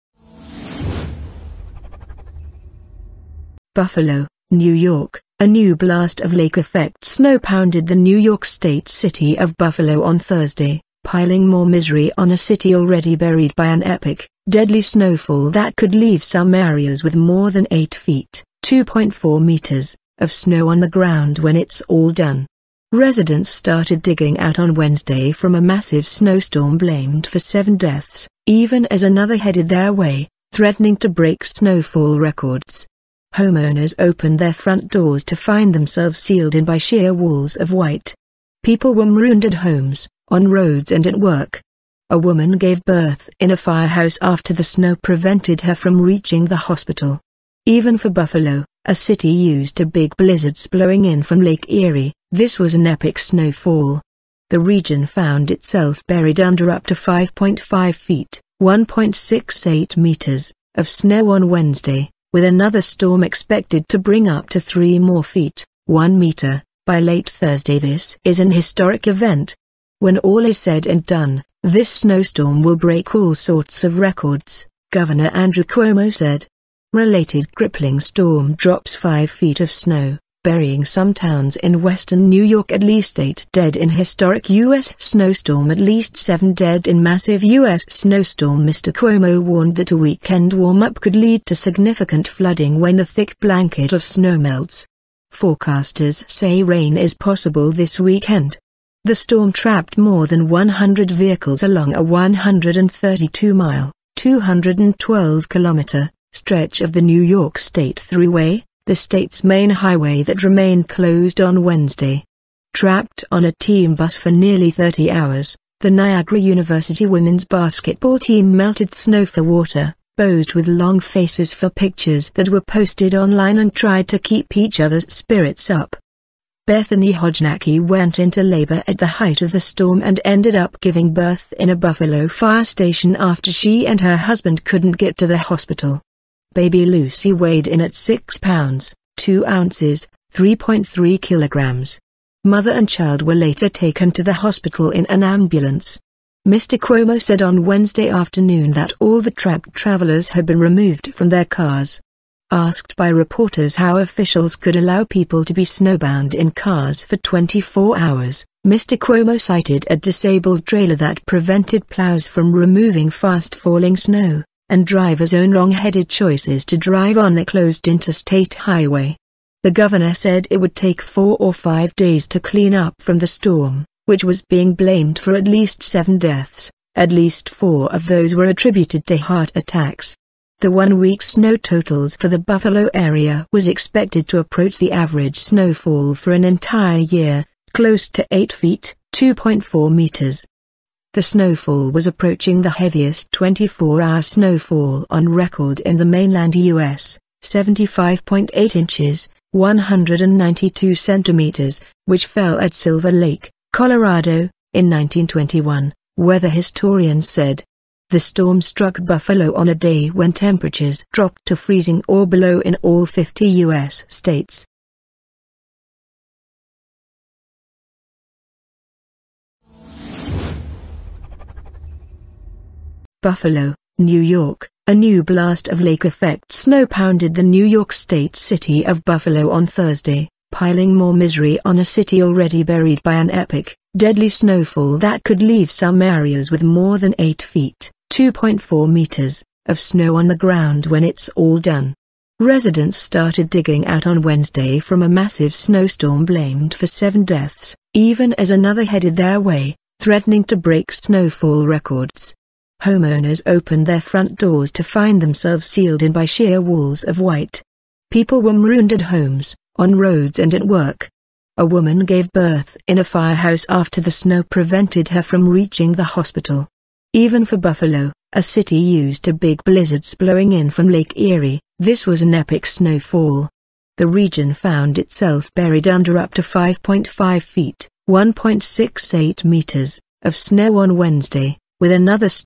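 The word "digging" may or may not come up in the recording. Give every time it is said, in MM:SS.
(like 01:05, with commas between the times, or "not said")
00:24, 04:03.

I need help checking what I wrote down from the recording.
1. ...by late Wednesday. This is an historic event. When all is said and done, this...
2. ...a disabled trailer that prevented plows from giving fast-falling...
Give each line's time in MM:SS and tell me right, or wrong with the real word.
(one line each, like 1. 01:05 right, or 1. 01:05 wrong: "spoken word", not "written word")
1. 01:06 wrong: "Thursday", not "Wednesday"
2. 02:39 wrong: "removing", not "giving".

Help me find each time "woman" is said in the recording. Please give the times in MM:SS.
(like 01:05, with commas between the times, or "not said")
00:42, 04:21.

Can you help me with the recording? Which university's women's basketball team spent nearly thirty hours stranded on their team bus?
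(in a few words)
Niagara University.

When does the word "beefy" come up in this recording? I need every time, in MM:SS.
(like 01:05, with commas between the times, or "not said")
not said.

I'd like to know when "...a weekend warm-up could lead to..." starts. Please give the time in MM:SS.
01:29.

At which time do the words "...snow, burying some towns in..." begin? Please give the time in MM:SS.
01:19.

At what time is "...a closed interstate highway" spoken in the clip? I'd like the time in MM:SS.
02:47.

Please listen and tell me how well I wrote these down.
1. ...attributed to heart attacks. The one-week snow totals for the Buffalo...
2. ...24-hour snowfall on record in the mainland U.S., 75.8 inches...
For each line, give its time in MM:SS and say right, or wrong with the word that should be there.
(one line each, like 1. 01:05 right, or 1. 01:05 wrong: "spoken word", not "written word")
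1. 02:58 right
2. 03:13 right.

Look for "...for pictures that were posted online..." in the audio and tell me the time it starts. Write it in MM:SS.
02:01.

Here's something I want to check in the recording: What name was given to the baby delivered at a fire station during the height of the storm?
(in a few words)
Lucy.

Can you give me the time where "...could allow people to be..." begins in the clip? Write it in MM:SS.
02:34.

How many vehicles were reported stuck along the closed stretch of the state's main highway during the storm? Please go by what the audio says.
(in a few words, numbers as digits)
more than 100.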